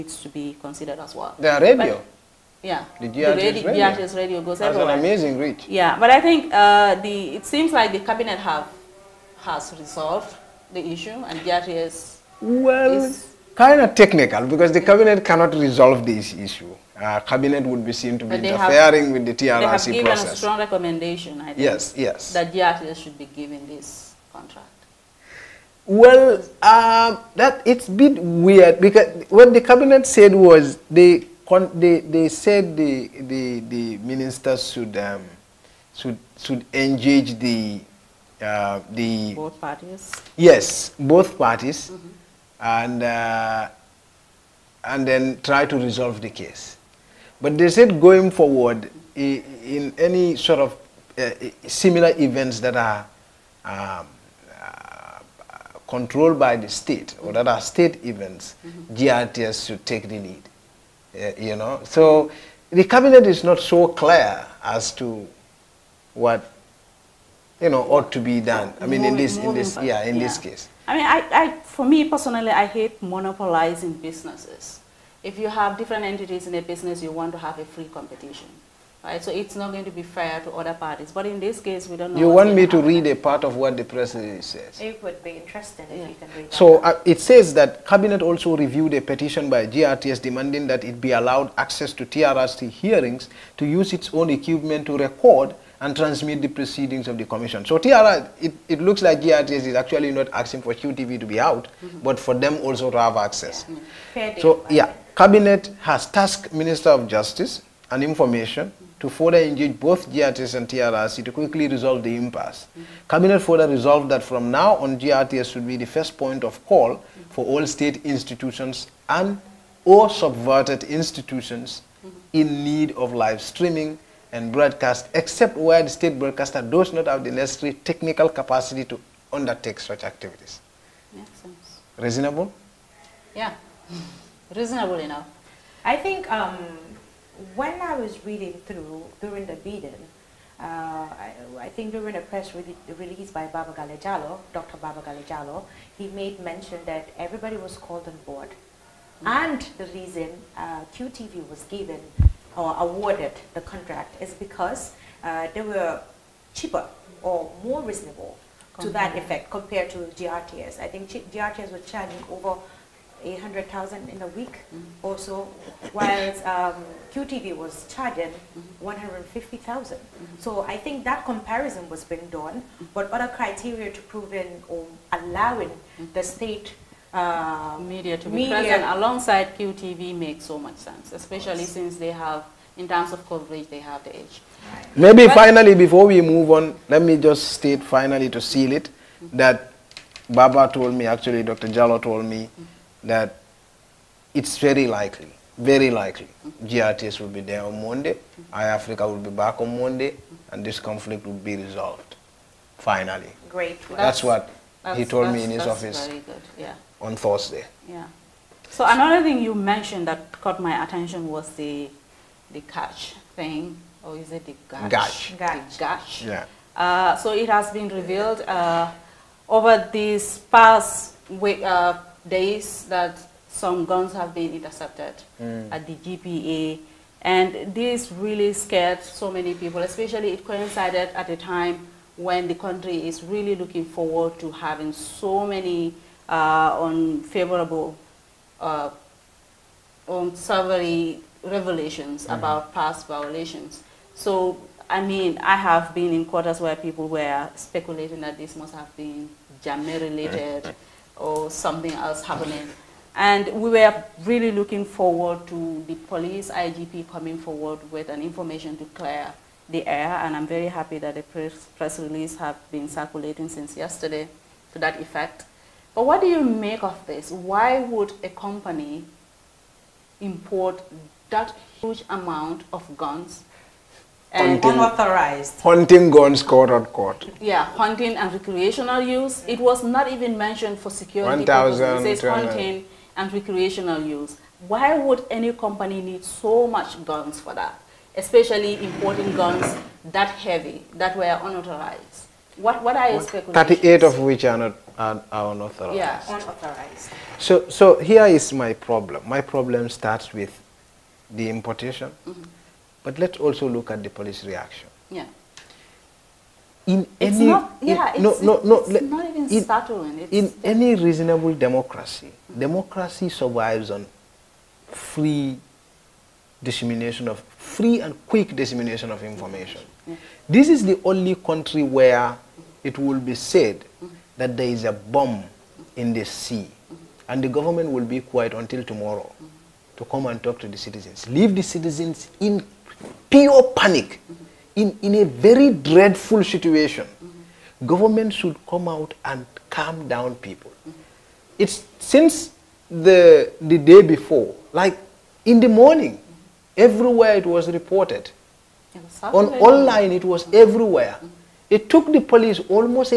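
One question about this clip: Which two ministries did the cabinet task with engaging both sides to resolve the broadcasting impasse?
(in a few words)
Justice and Information.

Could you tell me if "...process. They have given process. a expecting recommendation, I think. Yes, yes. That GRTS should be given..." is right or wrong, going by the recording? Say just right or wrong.
wrong.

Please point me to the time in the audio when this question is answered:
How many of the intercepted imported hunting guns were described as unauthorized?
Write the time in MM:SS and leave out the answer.
04:53.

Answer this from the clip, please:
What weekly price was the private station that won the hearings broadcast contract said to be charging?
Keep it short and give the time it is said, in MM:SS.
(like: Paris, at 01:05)
150,000, at 02:48.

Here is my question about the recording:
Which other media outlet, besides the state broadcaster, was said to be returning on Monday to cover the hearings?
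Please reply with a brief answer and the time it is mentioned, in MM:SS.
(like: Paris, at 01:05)
iAfrica, at 03:18.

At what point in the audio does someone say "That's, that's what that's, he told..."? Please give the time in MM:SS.
03:23.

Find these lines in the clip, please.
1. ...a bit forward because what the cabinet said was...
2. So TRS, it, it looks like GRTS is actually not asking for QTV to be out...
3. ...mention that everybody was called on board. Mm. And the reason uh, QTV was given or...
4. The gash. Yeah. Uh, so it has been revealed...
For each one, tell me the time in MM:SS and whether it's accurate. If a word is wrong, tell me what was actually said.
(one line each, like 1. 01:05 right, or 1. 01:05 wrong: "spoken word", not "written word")
1. 00:27 wrong: "weird", not "forward"
2. 01:37 right
3. 02:26 right
4. 03:35 right.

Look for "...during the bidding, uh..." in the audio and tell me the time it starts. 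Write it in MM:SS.
02:19.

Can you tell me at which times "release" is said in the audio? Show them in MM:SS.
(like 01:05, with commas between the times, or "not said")
02:22, 04:21.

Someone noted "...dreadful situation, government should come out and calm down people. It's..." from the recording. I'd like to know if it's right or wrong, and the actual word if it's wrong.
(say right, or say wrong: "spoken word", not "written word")
right.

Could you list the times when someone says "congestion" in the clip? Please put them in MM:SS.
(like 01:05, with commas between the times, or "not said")
not said.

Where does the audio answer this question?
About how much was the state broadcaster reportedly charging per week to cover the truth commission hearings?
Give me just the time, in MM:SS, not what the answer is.
02:42.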